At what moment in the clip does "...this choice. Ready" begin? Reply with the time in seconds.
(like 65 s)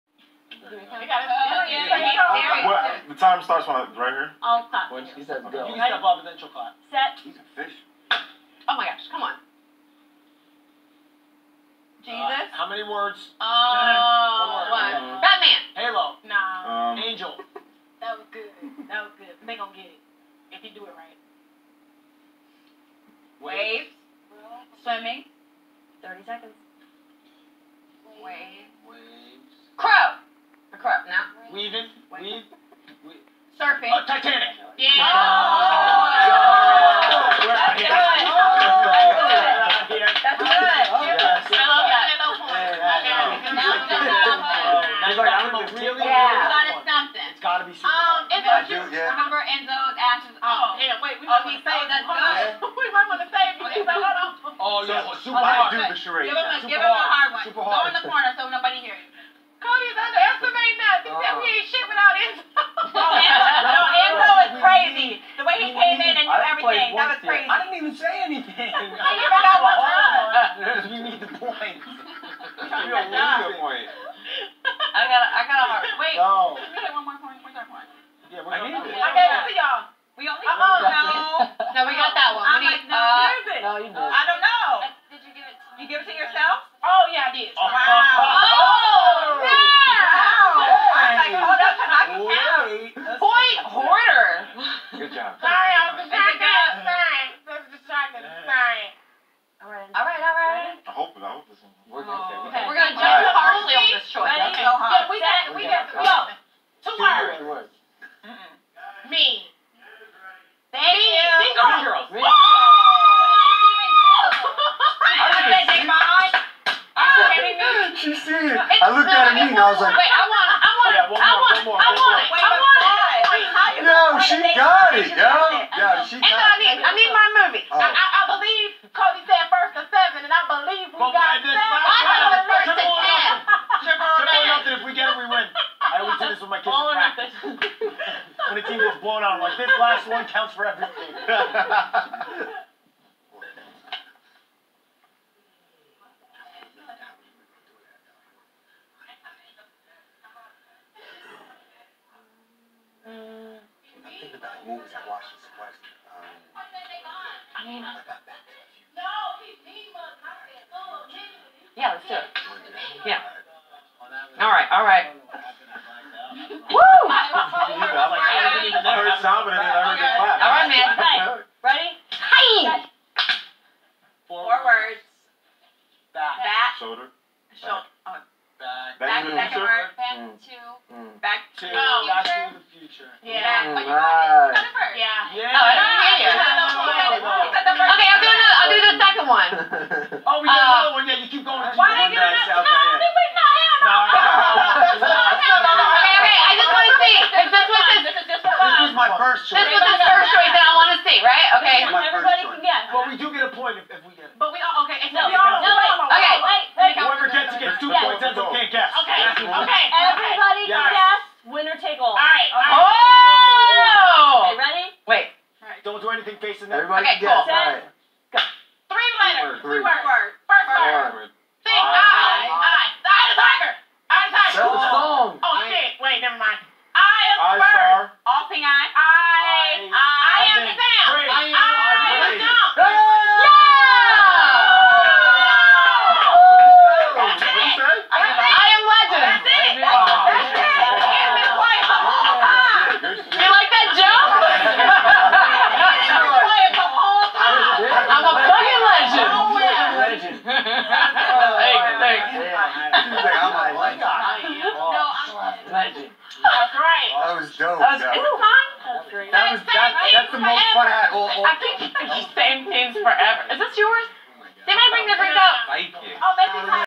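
103 s.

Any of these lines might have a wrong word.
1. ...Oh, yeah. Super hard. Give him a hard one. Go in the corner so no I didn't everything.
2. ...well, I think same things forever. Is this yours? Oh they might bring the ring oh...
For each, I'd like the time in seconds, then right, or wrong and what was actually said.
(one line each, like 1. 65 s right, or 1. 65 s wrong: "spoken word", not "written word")
1. 54 s right
2. 261 s right.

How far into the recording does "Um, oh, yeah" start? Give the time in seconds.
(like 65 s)
50 s.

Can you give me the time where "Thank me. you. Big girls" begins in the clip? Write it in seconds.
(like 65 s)
110 s.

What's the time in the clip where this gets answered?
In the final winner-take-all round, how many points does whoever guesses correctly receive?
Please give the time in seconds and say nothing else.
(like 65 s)
207 s.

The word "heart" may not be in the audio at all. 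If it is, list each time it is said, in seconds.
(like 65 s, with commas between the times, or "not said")
75 s.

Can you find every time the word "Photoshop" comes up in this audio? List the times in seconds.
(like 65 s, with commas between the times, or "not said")
not said.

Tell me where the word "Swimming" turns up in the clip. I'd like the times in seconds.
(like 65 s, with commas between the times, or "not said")
24 s.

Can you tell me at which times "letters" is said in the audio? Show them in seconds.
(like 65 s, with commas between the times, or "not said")
219 s.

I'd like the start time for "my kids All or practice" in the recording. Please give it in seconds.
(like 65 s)
136 s.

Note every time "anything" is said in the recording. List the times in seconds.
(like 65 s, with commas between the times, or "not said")
68 s, 216 s.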